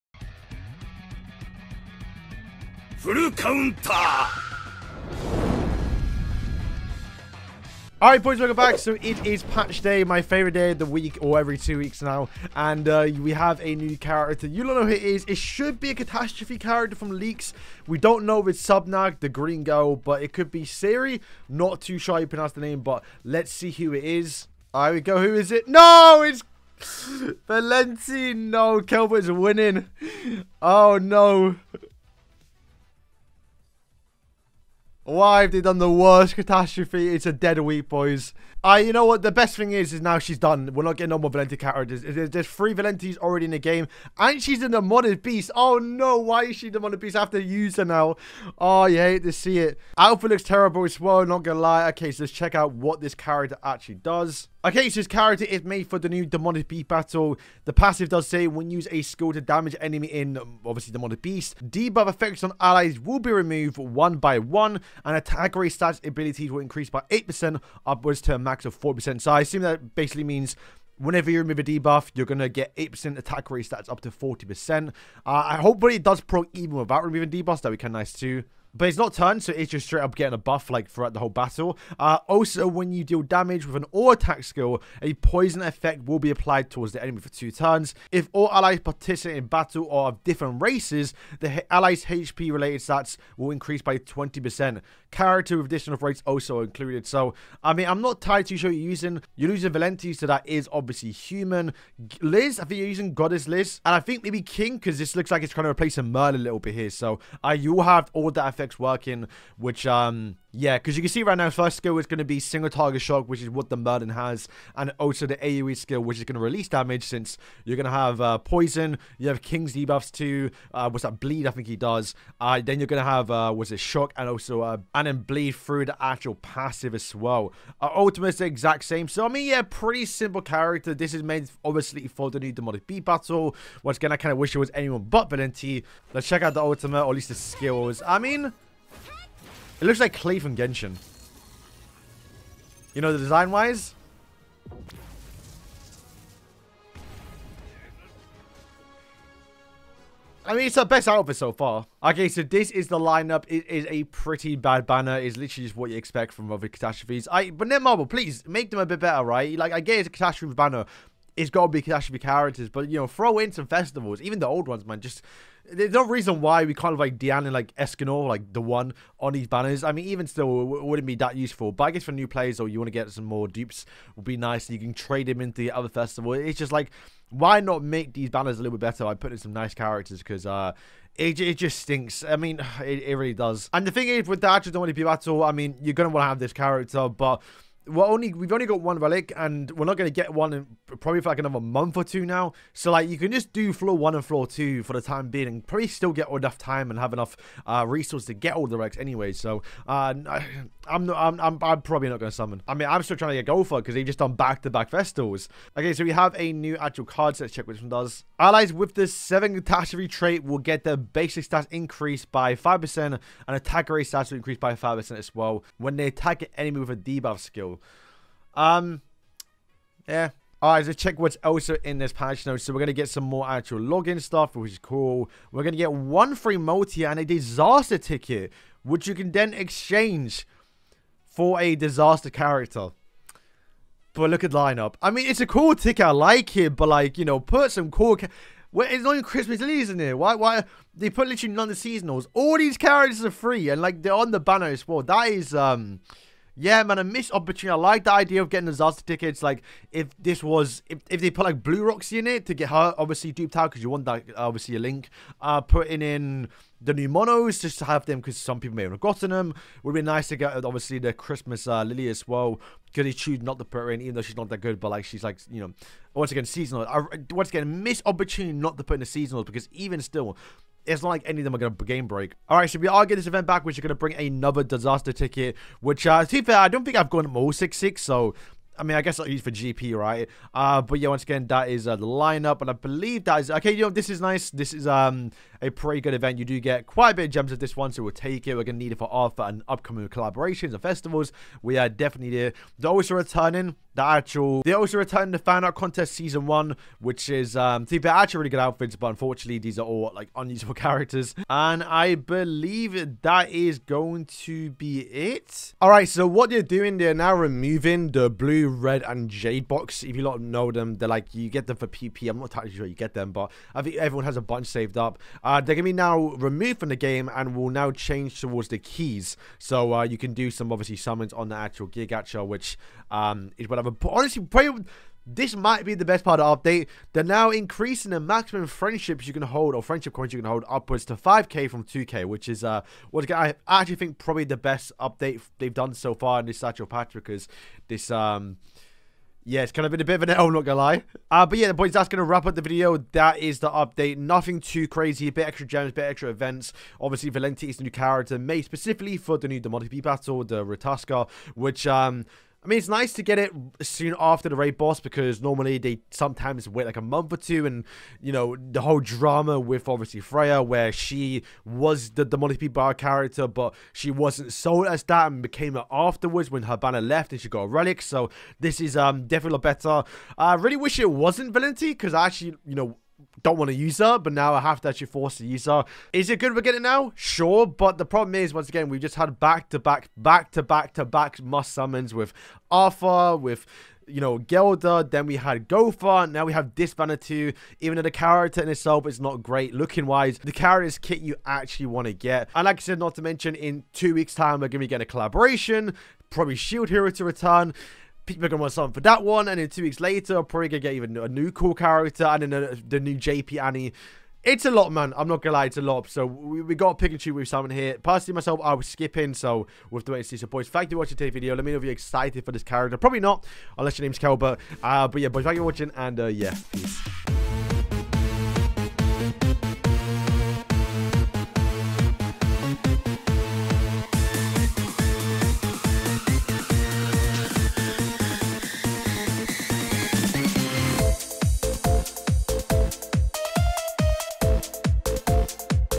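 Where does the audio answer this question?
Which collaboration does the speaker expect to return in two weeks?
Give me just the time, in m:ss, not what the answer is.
6:36.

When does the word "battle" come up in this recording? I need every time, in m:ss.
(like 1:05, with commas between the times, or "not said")
0:56, 1:21, 1:29, 2:13, 3:05, 5:50.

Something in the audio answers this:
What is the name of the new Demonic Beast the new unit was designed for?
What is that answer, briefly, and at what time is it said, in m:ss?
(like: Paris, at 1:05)
Ratatoskr, at 5:50.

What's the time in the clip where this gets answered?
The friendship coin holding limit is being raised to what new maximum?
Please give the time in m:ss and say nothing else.
5:31.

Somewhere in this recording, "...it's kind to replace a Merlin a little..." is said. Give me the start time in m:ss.
1:45.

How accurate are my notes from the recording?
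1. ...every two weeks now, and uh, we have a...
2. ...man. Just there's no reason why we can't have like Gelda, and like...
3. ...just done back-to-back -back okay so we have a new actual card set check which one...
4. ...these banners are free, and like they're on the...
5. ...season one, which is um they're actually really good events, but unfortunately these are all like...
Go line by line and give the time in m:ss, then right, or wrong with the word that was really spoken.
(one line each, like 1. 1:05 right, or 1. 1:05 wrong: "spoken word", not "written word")
1. 0:11 right
2. 2:44 wrong: "Diane", not "Gelda"
3. 3:24 right
4. 4:02 wrong: "characters", not "banners"
5. 4:56 wrong: "outfits", not "events".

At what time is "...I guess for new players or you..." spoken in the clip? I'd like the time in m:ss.
2:51.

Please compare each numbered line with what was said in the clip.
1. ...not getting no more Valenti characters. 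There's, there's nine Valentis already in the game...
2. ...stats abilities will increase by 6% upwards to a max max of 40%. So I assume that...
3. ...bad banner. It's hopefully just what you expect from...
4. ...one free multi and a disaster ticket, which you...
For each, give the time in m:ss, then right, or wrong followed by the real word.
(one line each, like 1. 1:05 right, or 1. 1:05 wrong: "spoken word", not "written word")
1. 0:40 wrong: "three", not "nine"
2. 1:05 wrong: "8", not "6"
3. 2:34 wrong: "literally", not "hopefully"
4. 3:45 right.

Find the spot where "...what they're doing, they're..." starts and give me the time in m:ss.
5:06.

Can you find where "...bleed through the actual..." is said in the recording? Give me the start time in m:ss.
2:05.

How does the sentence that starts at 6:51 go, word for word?
Let me know if you're excited for this character.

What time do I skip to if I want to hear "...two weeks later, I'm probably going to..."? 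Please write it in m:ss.
6:39.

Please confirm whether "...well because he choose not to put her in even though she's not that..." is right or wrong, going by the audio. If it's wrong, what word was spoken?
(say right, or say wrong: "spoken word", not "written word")
right.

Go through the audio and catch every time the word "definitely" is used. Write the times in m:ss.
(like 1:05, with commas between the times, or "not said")
4:51, 6:09.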